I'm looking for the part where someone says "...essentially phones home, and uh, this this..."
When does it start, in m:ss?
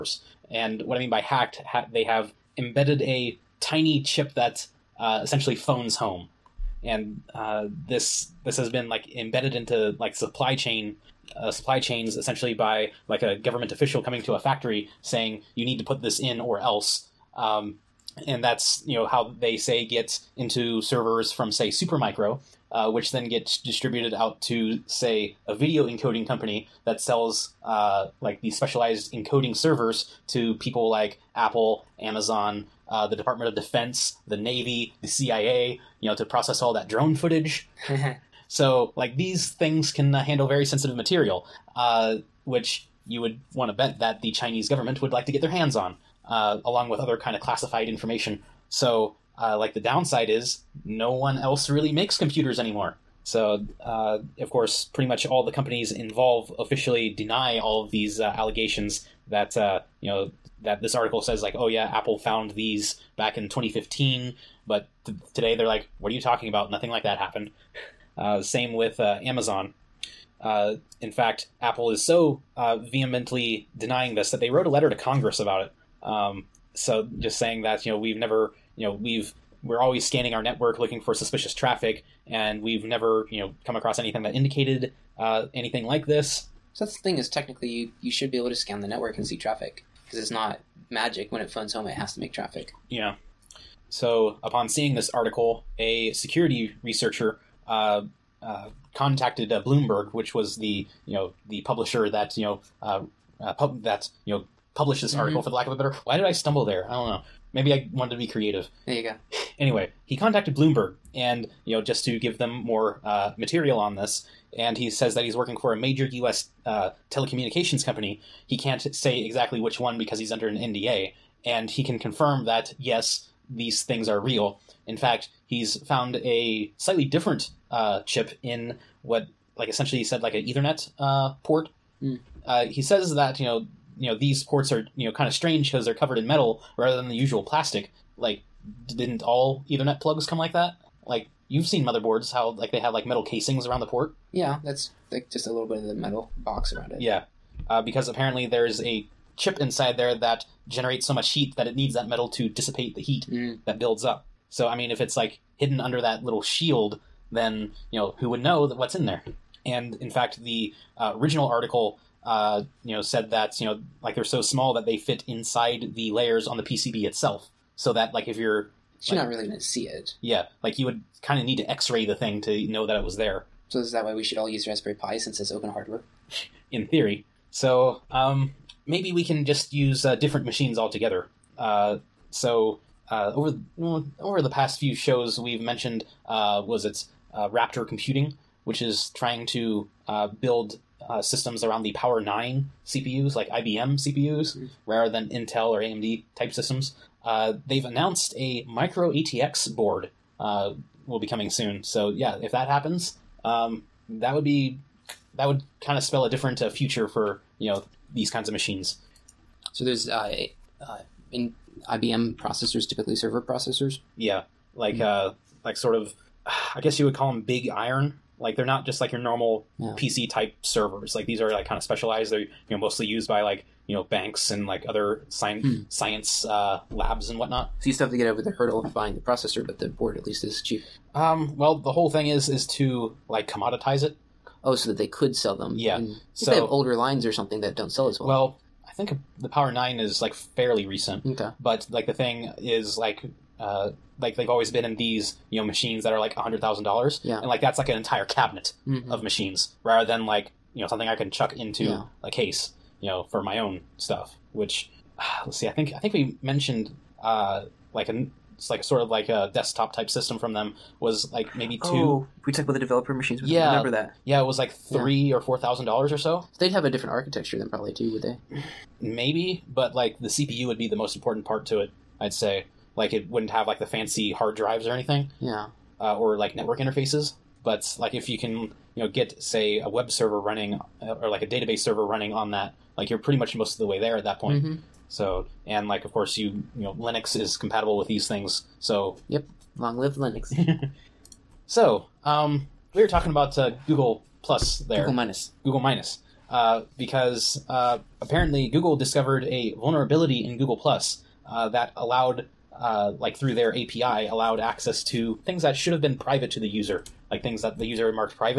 0:05.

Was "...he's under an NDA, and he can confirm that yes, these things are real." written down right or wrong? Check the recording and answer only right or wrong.
right.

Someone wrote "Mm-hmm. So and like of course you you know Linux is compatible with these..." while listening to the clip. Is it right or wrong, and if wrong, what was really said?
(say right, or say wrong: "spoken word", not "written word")
right.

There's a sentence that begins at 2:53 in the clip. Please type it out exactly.
So is that why we should all use Raspberry Pi since it's open hardware?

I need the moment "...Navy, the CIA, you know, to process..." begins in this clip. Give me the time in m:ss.
0:34.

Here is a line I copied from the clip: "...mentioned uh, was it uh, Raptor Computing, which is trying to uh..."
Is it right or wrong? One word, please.
right.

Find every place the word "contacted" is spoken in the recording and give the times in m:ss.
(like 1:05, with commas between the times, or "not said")
1:38, 1:50.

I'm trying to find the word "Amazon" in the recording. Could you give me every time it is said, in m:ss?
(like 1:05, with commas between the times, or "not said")
0:31, 1:09.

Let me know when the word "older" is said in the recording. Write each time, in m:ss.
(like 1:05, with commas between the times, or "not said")
3:56.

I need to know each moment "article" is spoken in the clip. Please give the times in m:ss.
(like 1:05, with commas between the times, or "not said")
1:00, 1:35, 1:45, 2:41.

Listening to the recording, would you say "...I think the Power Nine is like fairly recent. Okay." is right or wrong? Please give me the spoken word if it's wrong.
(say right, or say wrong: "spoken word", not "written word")
right.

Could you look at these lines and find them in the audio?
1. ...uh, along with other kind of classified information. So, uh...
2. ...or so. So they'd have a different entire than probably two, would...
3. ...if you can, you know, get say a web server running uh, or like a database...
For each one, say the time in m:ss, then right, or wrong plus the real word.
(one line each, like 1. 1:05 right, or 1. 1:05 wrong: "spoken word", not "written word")
1. 0:46 right
2. 4:26 wrong: "architecture", not "entire"
3. 4:38 right.